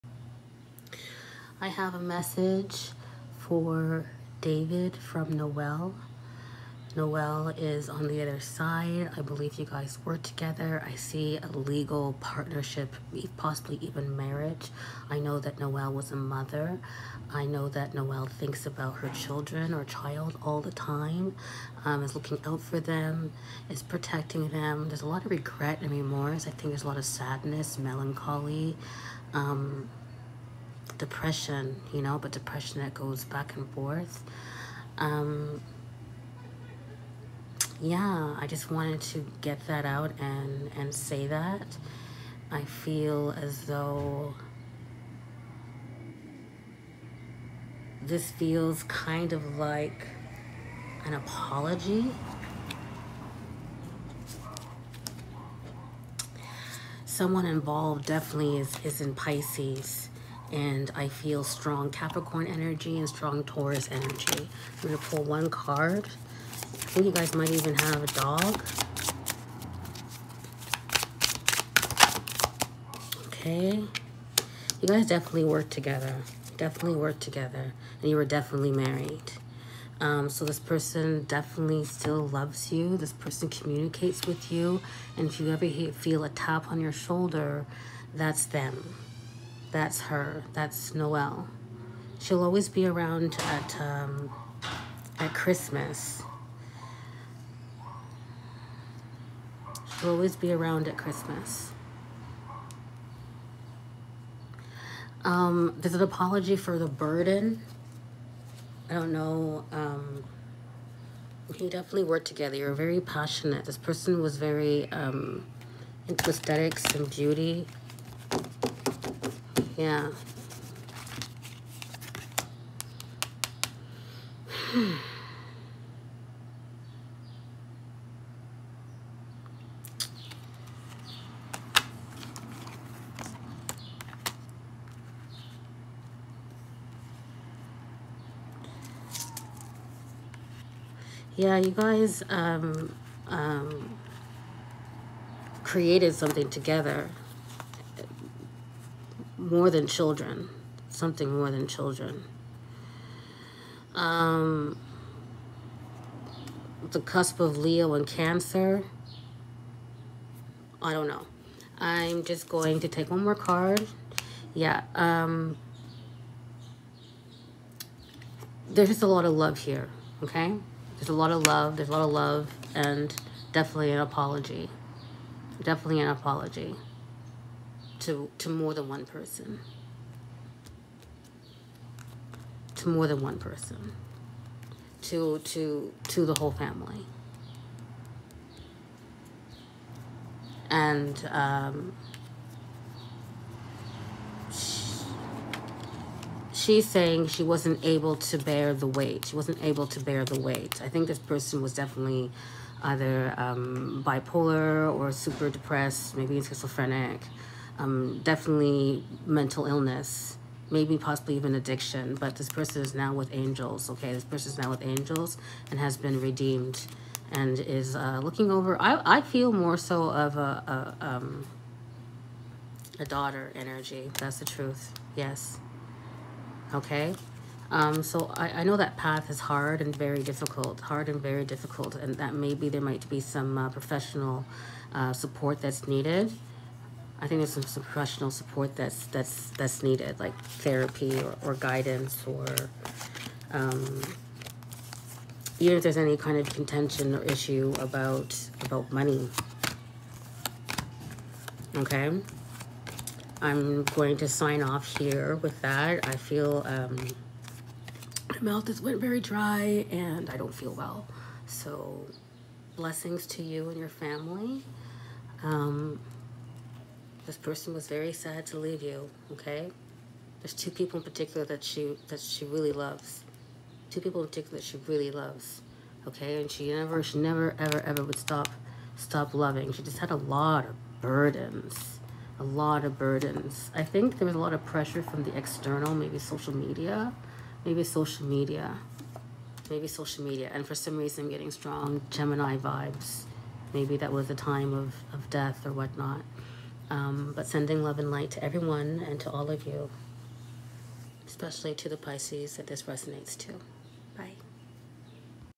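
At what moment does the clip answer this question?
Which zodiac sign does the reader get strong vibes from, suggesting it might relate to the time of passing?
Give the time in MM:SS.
04:52.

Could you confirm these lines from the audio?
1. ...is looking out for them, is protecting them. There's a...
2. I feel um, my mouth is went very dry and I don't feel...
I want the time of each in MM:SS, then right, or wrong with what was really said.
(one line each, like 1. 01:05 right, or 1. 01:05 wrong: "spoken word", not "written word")
1. 00:22 right
2. 04:16 right.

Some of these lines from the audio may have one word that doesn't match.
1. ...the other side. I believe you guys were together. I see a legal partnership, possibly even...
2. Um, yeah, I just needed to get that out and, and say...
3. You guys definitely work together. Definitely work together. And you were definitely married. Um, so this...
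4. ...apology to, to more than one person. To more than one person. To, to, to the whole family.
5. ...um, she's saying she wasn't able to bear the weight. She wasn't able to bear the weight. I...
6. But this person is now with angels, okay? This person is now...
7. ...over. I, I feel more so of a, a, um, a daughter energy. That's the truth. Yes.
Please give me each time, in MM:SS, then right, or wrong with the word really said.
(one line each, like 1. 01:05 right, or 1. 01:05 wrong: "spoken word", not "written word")
1. 00:08 right
2. 00:34 wrong: "wanted", not "needed"
3. 01:14 right
4. 02:56 right
5. 03:11 right
6. 03:32 right
7. 03:38 right.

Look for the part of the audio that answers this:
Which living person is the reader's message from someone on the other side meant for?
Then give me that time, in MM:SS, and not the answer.
00:04.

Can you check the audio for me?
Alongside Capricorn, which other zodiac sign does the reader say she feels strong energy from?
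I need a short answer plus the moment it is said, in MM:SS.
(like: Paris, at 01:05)
Taurus, at 01:03.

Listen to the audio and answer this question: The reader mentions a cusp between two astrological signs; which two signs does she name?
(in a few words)
Leo and Cancer.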